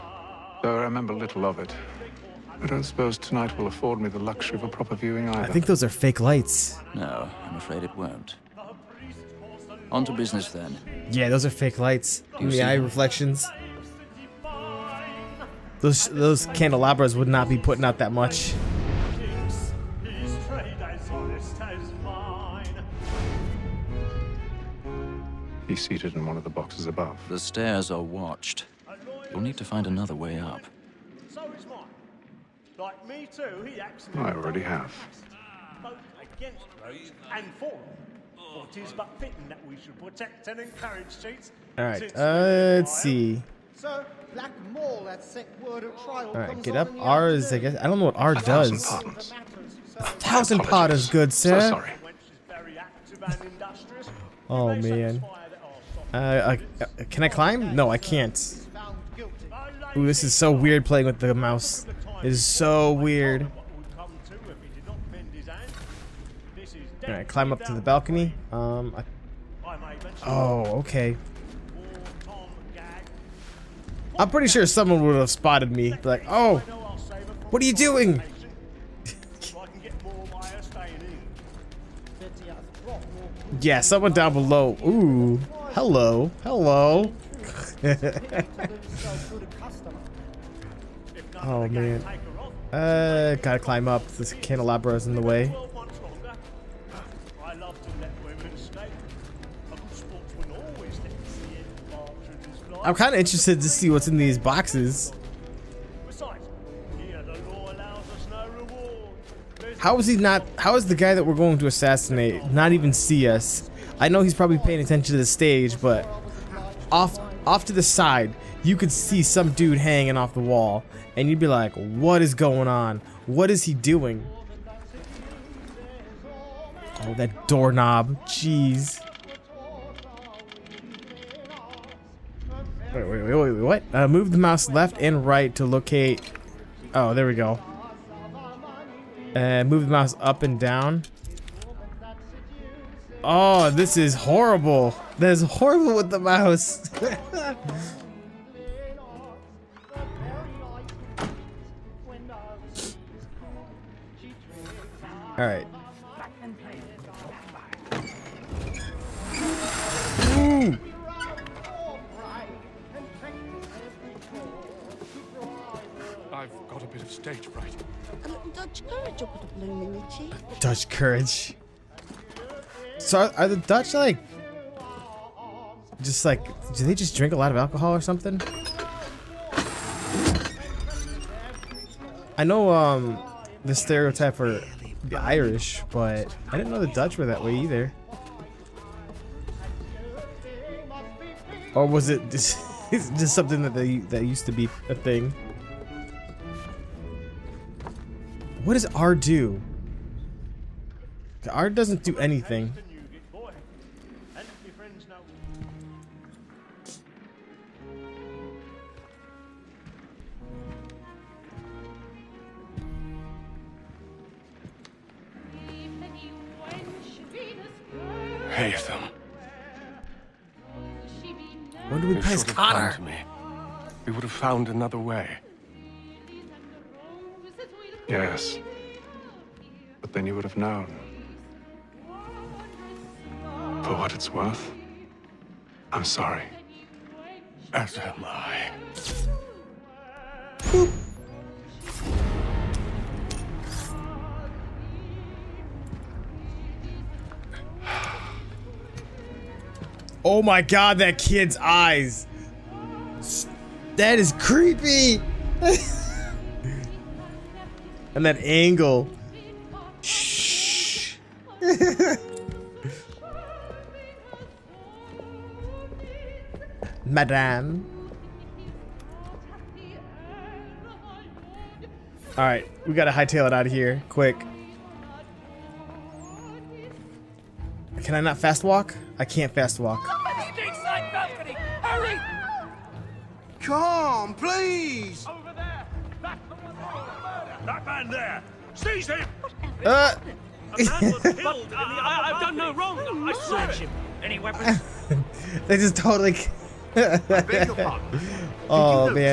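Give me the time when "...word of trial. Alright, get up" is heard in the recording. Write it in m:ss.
0:45.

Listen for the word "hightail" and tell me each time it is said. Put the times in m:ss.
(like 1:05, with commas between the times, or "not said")
4:33.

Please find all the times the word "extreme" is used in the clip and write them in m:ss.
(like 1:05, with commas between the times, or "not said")
not said.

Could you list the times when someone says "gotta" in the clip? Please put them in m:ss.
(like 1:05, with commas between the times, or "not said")
1:33, 4:32.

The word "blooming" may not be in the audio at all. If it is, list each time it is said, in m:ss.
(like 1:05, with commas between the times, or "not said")
2:49.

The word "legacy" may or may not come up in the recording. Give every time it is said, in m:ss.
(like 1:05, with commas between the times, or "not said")
not said.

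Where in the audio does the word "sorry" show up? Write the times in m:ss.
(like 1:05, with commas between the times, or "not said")
0:51, 3:56.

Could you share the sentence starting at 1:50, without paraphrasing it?
How is the guy that we're going to assassinate not even see us?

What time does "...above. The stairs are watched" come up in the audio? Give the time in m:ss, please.
0:26.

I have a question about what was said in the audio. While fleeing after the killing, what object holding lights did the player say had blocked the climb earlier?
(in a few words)
candelabra.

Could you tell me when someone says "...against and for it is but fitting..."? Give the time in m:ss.
0:36.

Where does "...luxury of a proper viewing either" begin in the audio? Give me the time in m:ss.
0:04.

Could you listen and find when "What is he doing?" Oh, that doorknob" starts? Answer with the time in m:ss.
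2:03.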